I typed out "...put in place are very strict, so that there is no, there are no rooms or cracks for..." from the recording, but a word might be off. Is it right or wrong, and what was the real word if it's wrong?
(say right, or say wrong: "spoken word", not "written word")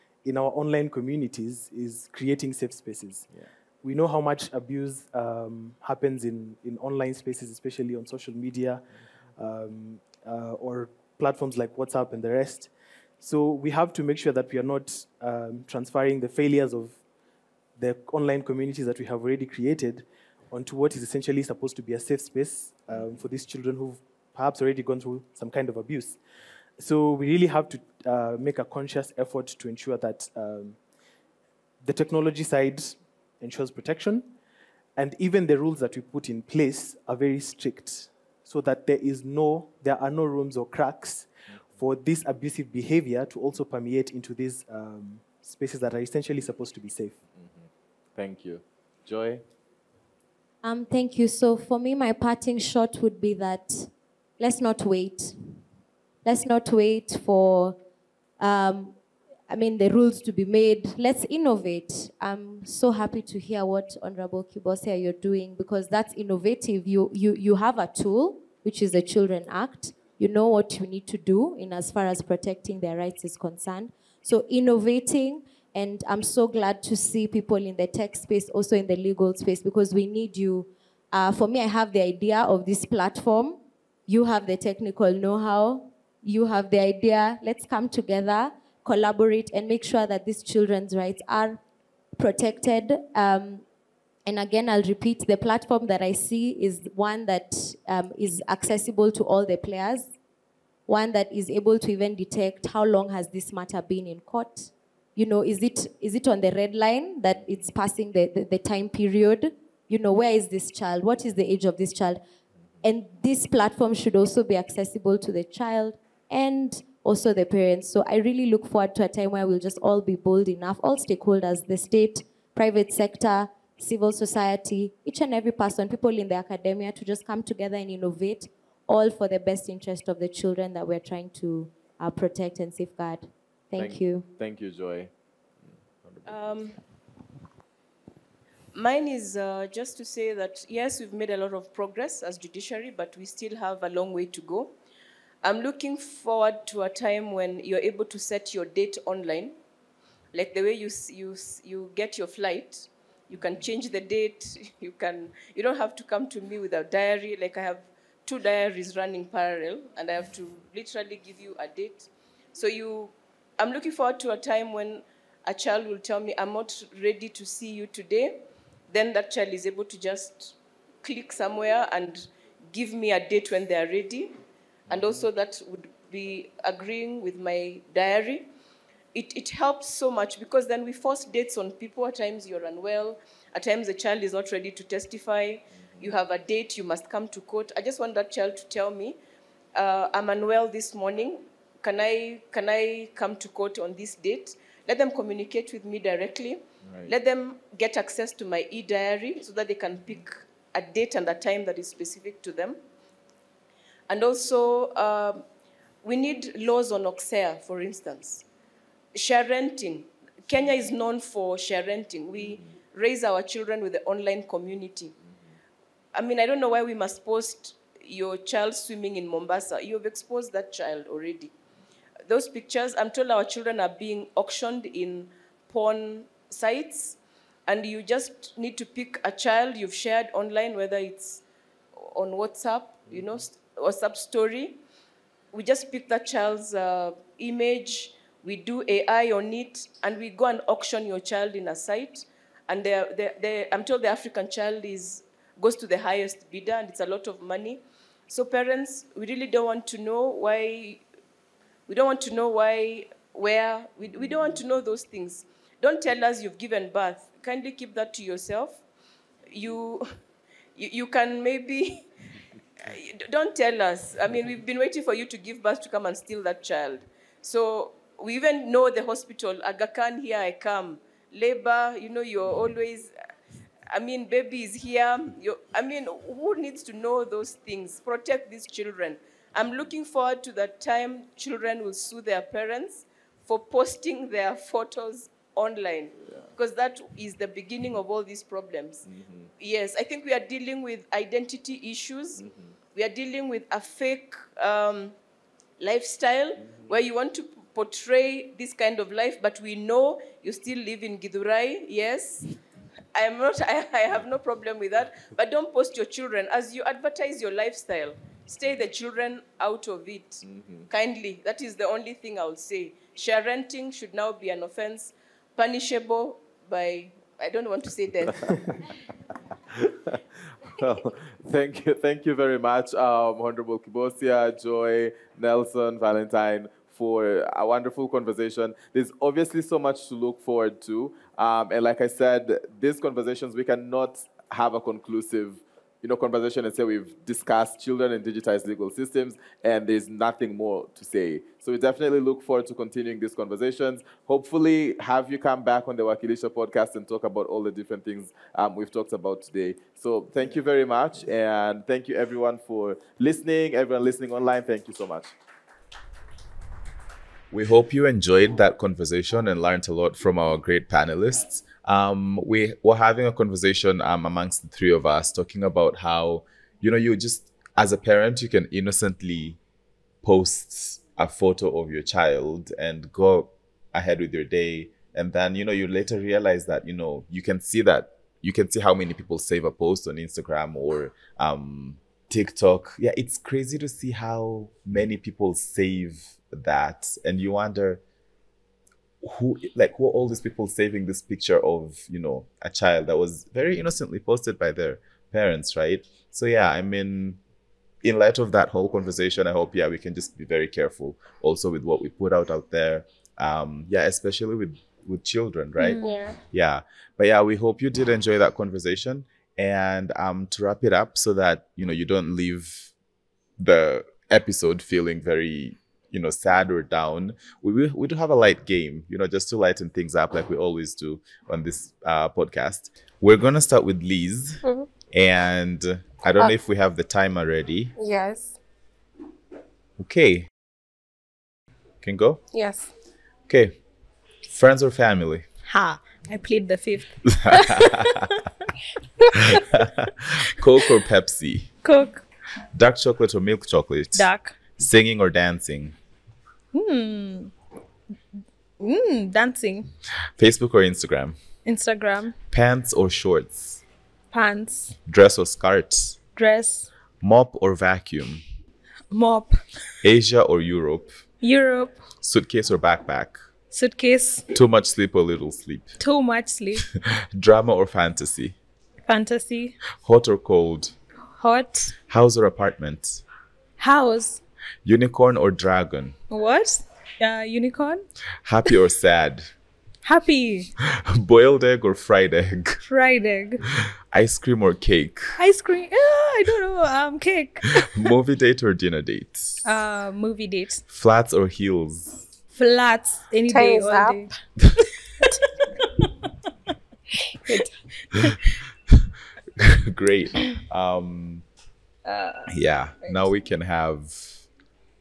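right.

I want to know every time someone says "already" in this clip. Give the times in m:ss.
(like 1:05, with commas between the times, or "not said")
0:19, 0:24, 3:41.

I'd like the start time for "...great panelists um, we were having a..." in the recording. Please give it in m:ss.
6:00.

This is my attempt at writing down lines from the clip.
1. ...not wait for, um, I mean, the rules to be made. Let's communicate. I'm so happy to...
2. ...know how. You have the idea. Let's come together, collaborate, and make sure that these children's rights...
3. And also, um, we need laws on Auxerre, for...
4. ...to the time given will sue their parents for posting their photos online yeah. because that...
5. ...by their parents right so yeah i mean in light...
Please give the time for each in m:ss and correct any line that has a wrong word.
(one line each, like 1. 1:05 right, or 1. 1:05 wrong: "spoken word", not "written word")
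1. 0:56 wrong: "innovate", not "communicate"
2. 1:25 right
3. 3:24 right
4. 4:40 wrong: "children", not "given"
5. 6:34 right.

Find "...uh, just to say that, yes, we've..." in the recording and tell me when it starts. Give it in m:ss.
2:19.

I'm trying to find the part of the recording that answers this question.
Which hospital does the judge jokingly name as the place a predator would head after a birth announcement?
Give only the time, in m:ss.
4:29.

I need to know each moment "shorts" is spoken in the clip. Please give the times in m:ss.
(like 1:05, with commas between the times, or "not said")
7:33.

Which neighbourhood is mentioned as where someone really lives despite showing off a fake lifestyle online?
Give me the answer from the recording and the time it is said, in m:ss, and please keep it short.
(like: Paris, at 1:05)
Githurai, at 5:01.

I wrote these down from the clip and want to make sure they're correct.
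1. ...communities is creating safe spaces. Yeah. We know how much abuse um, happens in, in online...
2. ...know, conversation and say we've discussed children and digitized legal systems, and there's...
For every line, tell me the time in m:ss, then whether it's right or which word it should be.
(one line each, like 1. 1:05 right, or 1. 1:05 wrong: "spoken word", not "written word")
1. 0:00 right
2. 5:36 right.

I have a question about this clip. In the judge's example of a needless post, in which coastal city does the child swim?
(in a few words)
Mombasa.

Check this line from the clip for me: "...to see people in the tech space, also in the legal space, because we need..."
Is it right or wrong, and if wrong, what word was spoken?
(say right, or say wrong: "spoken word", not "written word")
right.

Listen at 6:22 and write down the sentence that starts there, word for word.
Yeah, it's crazy to see how many people save that.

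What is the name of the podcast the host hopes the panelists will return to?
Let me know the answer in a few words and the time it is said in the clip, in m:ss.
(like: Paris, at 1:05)
Wakilisha, at 5:46.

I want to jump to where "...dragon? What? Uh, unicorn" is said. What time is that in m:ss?
7:55.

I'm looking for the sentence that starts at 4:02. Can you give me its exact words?
And they're, they're, they're, I'm told the African child is goes to the highest bidder, and it's a lot of money.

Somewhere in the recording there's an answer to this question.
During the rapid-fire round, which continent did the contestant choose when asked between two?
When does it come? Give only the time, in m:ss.
7:41.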